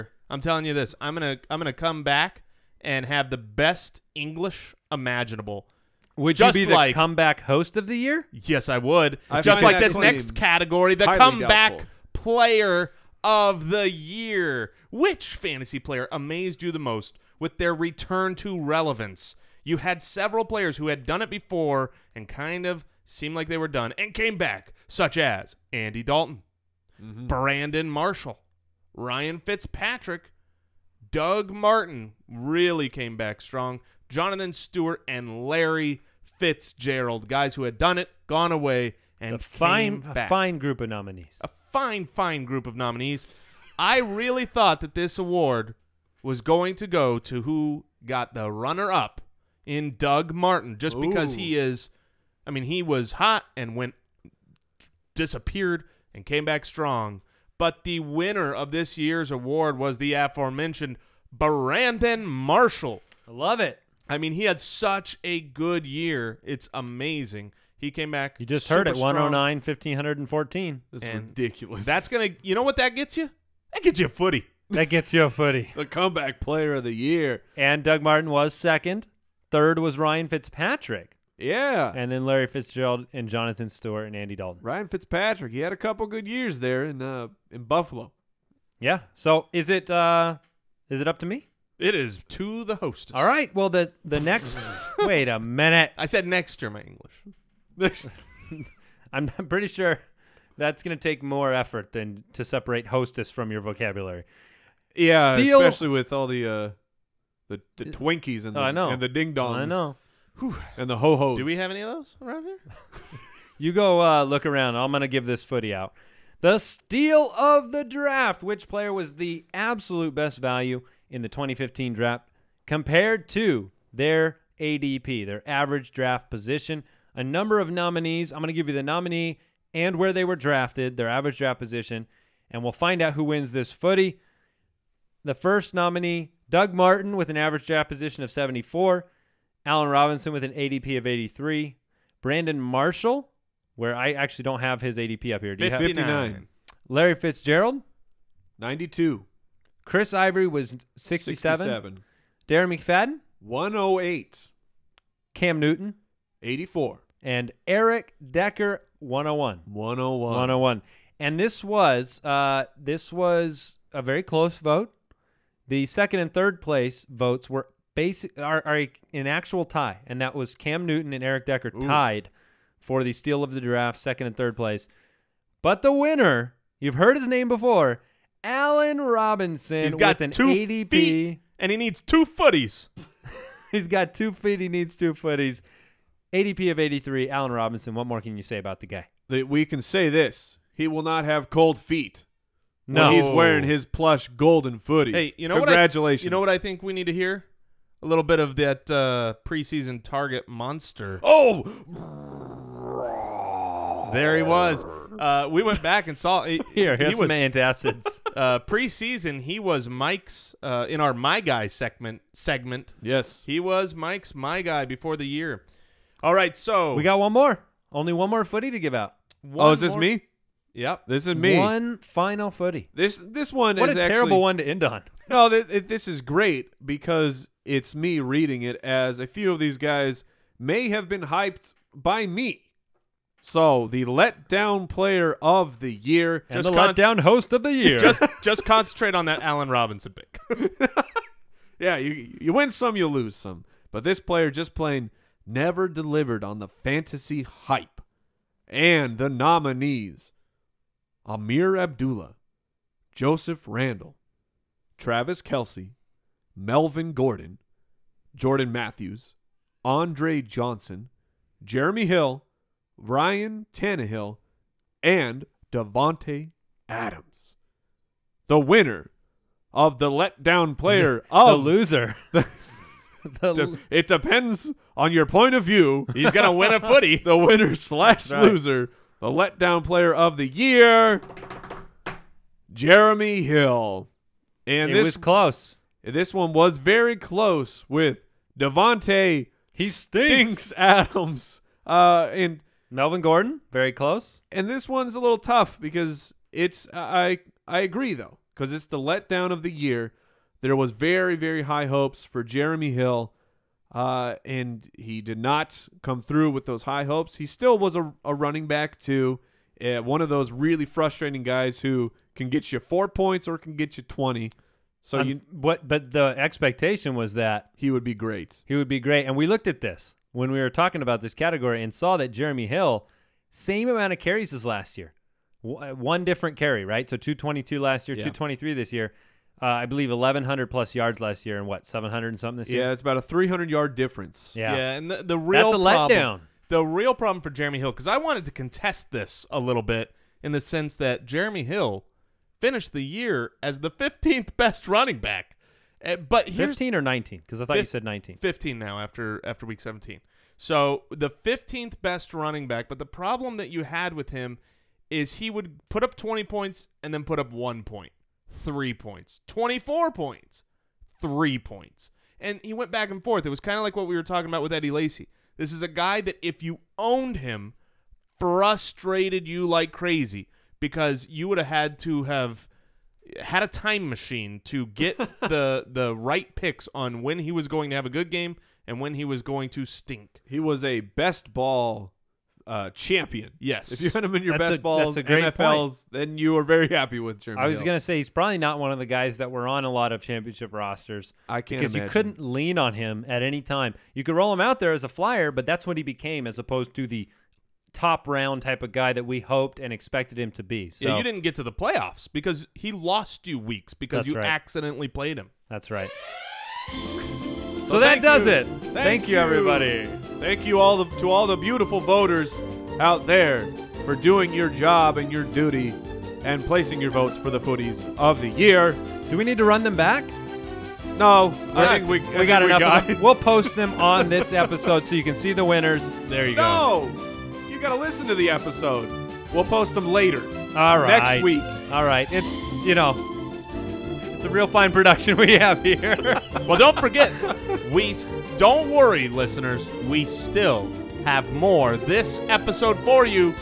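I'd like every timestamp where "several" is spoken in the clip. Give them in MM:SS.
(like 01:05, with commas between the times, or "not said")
00:20.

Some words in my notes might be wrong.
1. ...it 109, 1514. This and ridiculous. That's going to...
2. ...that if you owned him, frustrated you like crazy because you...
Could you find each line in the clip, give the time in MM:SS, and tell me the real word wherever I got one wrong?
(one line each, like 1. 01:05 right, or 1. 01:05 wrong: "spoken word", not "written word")
1. 01:08 right
2. 06:06 right.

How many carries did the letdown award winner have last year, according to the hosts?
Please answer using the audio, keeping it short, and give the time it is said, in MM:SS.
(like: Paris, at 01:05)
222, at 05:27.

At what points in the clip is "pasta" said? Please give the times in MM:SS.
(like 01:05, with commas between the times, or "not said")
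not said.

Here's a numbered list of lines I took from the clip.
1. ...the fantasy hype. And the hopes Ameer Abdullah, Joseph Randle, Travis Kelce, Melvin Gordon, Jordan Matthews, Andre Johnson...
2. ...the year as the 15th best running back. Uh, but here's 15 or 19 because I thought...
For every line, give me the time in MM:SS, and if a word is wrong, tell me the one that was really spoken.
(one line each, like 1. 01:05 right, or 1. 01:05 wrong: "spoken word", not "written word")
1. 04:06 wrong: "nominees", not "hopes"
2. 05:42 right.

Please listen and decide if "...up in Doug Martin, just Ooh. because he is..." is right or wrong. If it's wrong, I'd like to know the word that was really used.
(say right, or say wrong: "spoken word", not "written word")
right.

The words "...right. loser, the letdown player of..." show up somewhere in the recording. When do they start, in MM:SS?
04:38.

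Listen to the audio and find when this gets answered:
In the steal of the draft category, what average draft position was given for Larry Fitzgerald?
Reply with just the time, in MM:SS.
02:26.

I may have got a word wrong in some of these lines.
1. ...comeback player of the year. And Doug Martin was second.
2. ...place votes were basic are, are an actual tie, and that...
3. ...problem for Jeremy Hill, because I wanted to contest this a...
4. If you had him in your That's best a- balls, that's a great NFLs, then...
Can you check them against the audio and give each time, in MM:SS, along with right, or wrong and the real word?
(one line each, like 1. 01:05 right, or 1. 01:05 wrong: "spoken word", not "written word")
1. 01:15 right
2. 02:46 right
3. 05:37 right
4. 06:23 right.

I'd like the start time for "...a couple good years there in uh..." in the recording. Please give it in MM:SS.
01:25.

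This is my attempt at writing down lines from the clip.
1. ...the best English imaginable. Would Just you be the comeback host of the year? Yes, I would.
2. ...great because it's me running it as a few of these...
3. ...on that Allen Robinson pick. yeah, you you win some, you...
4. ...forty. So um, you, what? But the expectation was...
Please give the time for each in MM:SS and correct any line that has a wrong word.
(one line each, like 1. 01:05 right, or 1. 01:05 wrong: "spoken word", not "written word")
1. 00:03 right
2. 03:46 wrong: "reading", not "running"
3. 03:59 right
4. 05:14 wrong: "twenty", not "forty".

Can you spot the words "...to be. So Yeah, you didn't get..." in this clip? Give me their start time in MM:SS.
06:40.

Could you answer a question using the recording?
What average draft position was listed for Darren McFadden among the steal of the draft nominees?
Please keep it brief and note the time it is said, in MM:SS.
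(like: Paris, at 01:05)
108, at 02:32.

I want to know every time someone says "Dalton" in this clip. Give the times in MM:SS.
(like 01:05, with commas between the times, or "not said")
00:26, 01:24.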